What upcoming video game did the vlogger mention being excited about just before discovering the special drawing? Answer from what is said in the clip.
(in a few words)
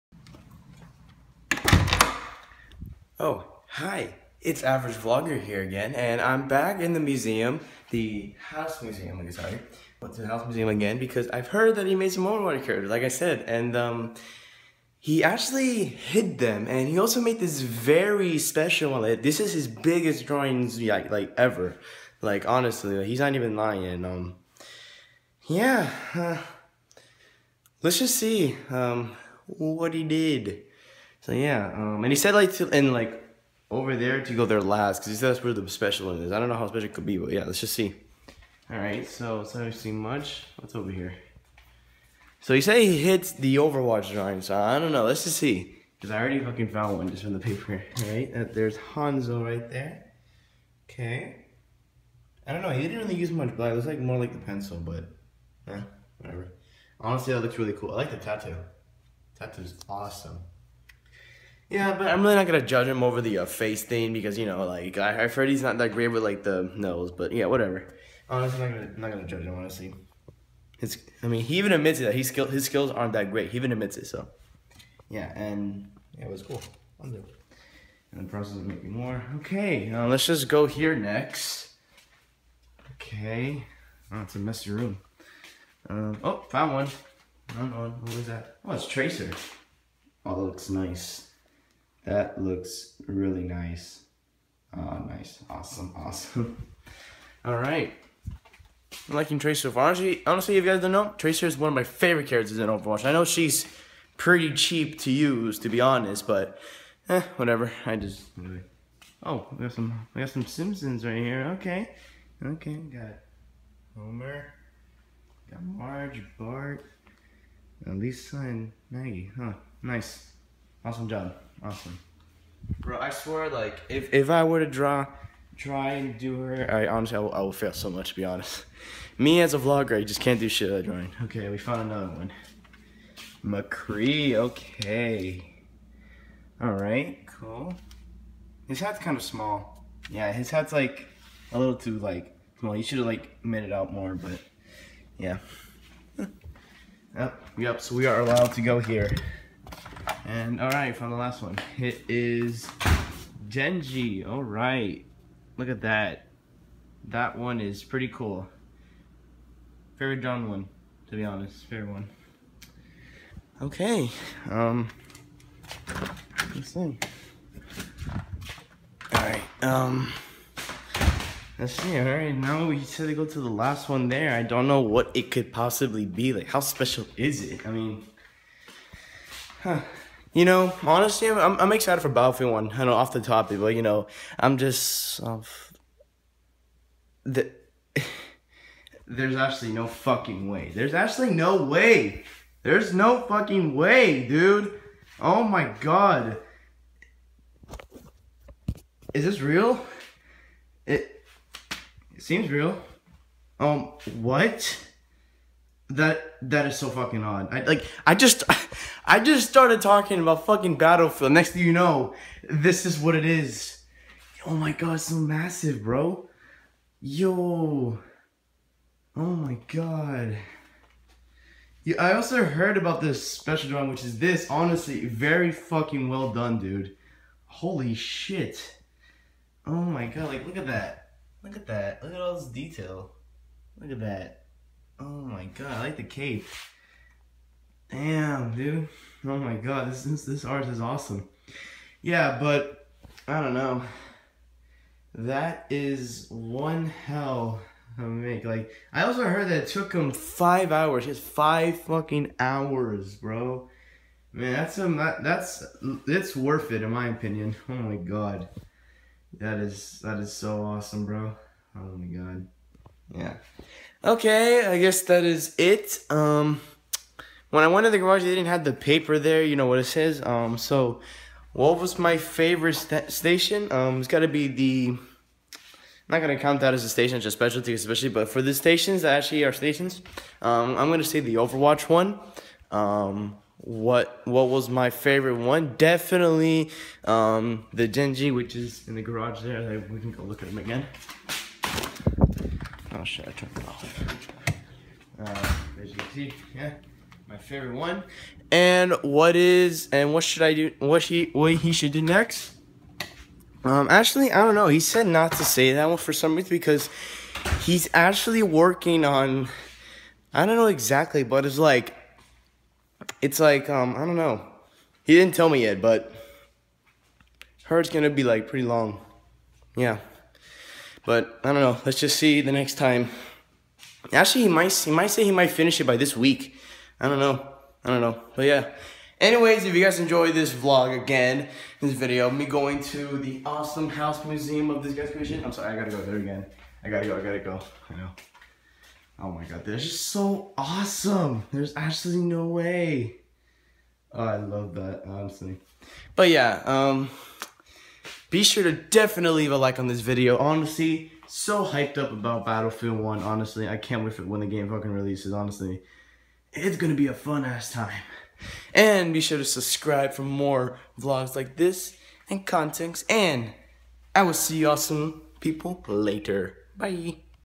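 Battlefield 1.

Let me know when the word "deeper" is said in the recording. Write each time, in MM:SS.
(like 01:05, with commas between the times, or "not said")
not said.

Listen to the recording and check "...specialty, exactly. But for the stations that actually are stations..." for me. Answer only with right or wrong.
wrong.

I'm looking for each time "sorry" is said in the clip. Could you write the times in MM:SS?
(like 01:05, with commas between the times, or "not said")
00:09, 05:35.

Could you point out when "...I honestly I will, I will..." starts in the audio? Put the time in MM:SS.
02:06.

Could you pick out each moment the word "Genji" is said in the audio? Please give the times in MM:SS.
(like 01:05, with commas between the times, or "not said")
02:33, 04:47.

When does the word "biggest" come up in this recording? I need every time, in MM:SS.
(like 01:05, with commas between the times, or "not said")
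00:19.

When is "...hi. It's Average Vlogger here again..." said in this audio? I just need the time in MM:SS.
00:03.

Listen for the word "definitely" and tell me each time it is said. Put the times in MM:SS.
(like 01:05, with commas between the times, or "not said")
04:45, 05:48.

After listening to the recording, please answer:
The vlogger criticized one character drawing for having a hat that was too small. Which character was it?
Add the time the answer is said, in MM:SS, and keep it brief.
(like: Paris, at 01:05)
McCree, at 02:13.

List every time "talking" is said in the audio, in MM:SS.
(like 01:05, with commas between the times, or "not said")
03:29.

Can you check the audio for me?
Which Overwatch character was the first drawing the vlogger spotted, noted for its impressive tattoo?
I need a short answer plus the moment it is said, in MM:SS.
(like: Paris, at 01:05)
Hanzo, at 00:48.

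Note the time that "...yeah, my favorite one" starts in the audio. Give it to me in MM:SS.
04:56.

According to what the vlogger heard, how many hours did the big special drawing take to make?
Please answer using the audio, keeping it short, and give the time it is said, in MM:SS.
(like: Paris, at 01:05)
5 hours, at 04:10.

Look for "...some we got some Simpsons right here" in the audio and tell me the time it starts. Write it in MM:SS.
01:49.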